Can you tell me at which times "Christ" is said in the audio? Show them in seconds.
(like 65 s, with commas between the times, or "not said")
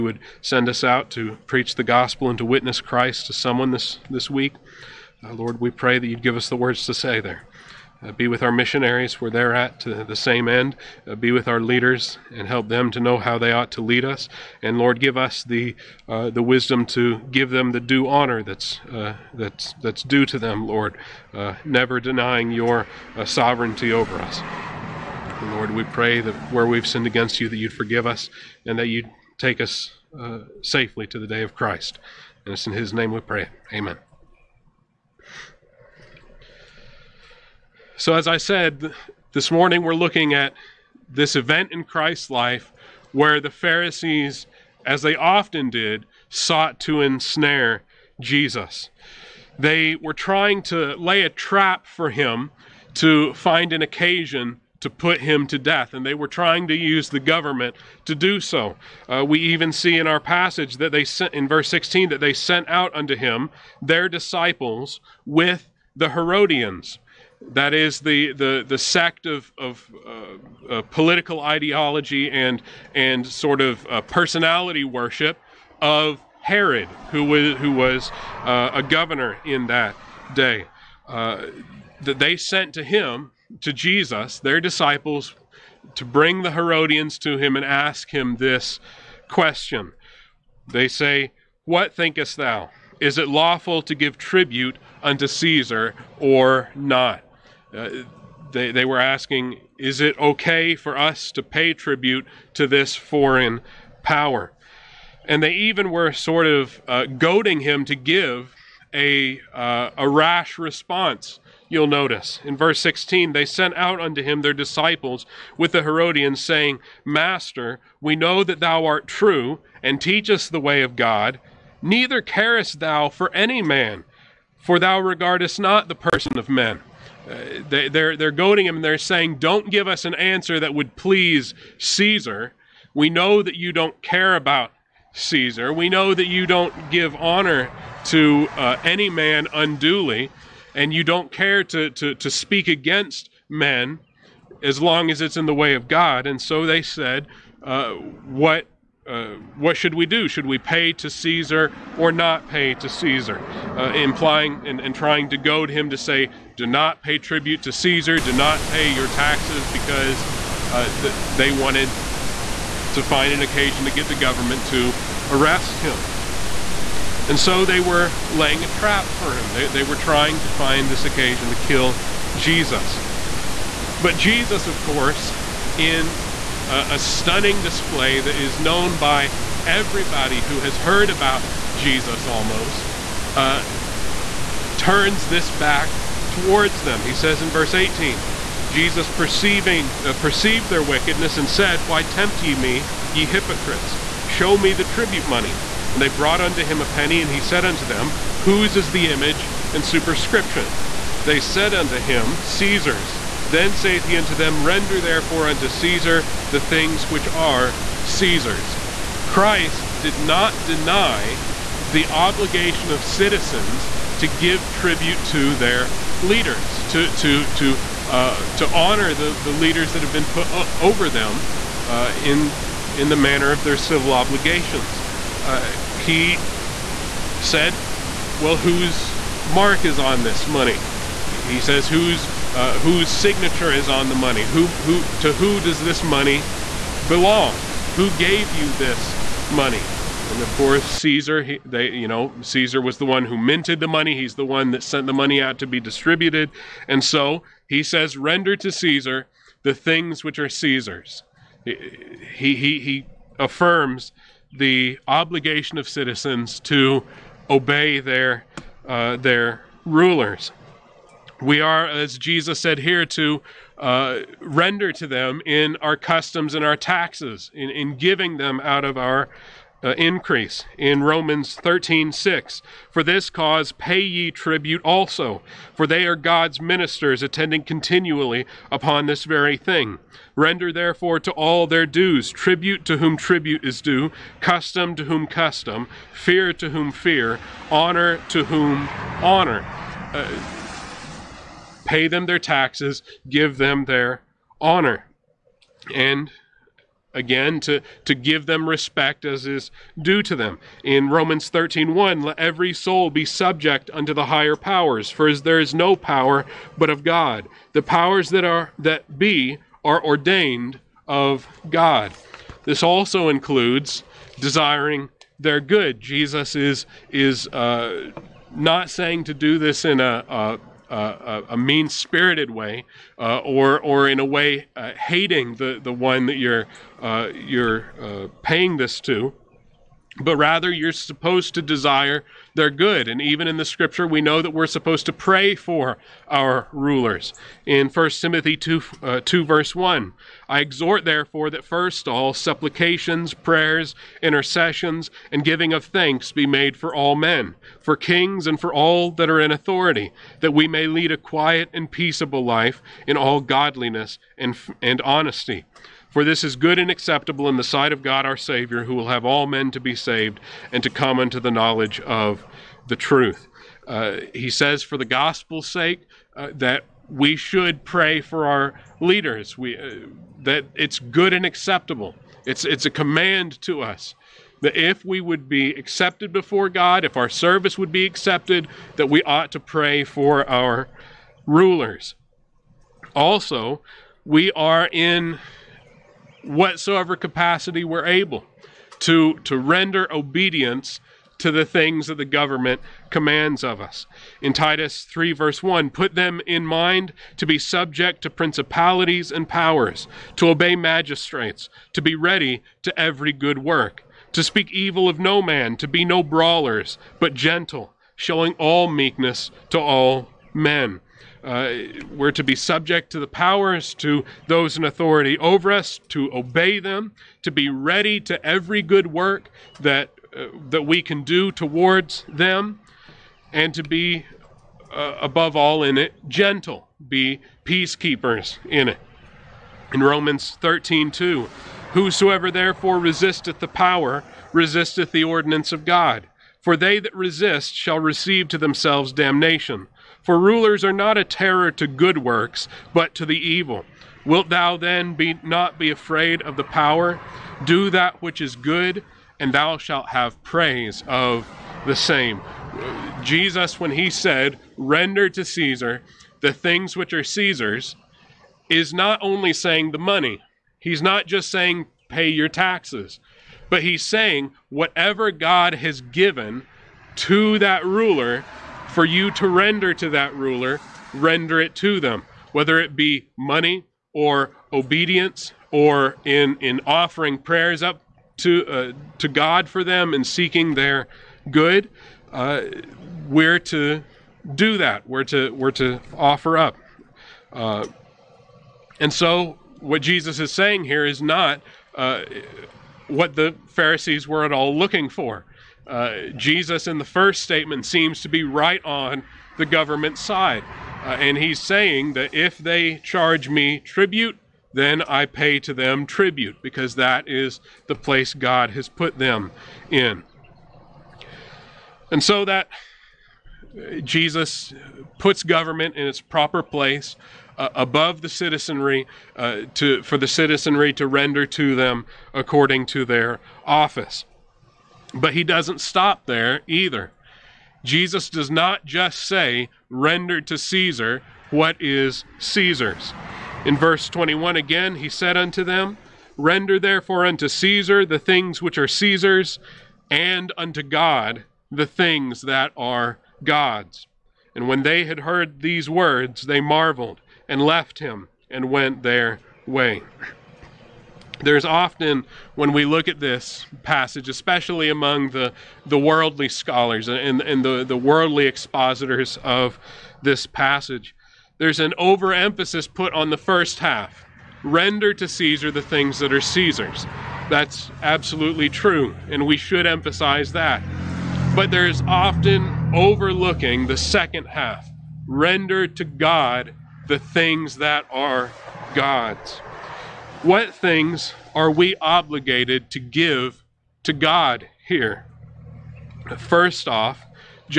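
2 s, 31 s, 41 s, 209 s.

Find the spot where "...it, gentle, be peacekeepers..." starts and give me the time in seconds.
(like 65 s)
425 s.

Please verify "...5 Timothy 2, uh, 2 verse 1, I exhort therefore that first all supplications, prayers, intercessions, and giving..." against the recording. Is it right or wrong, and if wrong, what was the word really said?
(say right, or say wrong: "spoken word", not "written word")
wrong: "1", not "5".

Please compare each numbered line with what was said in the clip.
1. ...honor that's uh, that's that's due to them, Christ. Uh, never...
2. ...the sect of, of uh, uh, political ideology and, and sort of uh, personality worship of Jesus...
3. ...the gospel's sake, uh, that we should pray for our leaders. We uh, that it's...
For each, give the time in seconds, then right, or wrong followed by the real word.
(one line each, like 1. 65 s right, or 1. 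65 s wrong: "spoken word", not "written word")
1. 18 s wrong: "Lord", not "Christ"
2. 68 s wrong: "Herod", not "Jesus"
3. 364 s right.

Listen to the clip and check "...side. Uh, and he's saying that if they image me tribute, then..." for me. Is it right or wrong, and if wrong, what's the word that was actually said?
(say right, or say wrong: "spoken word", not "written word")
wrong: "charge", not "image".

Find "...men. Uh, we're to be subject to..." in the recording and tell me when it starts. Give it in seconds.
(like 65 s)
410 s.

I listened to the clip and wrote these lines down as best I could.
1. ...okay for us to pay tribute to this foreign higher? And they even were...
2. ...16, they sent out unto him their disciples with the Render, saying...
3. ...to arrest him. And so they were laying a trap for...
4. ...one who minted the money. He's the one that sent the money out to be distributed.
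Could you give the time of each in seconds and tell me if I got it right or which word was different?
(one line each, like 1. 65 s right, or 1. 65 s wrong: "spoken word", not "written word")
1. 100 s wrong: "power", not "higher"
2. 112 s wrong: "Herodians", not "Render"
3. 164 s right
4. 243 s right.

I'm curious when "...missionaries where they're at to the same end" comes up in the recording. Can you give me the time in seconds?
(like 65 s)
8 s.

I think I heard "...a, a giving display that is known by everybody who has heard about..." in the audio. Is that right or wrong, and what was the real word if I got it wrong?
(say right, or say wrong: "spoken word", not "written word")
wrong: "stunning", not "giving".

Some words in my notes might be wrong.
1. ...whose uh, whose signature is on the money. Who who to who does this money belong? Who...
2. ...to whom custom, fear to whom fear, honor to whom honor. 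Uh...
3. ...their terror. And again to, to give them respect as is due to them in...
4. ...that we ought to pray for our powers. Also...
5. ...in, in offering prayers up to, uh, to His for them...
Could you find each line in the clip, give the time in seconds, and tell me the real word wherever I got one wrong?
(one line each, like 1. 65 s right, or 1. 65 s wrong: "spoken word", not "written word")
1. 231 s right
2. 284 s right
3. 293 s wrong: "honor", not "terror"
4. 378 s wrong: "rulers", not "powers"
5. 476 s wrong: "God", not "His".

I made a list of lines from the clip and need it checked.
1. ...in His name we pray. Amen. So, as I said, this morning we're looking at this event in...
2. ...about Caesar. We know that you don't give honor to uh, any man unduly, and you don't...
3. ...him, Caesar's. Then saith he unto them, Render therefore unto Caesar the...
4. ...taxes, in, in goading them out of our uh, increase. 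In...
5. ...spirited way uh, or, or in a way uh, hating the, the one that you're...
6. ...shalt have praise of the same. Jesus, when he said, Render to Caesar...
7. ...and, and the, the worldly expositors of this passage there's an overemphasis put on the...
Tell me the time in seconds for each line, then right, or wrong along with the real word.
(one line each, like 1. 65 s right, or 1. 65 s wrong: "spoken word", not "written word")
1. 32 s right
2. 134 s right
3. 201 s right
4. 266 s wrong: "giving", not "goading"
5. 321 s right
6. 449 s right
7. 557 s right.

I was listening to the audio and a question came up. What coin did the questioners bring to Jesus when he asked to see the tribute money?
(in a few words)
A penny.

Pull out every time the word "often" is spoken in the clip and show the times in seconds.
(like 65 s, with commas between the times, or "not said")
45 s, 551 s, 572 s.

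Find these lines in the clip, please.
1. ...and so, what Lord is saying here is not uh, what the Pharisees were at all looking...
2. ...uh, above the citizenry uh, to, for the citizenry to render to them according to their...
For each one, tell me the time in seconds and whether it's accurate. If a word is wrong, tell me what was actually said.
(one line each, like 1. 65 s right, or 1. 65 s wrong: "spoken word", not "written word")
1. 489 s wrong: "Jesus", not "Lord"
2. 517 s right.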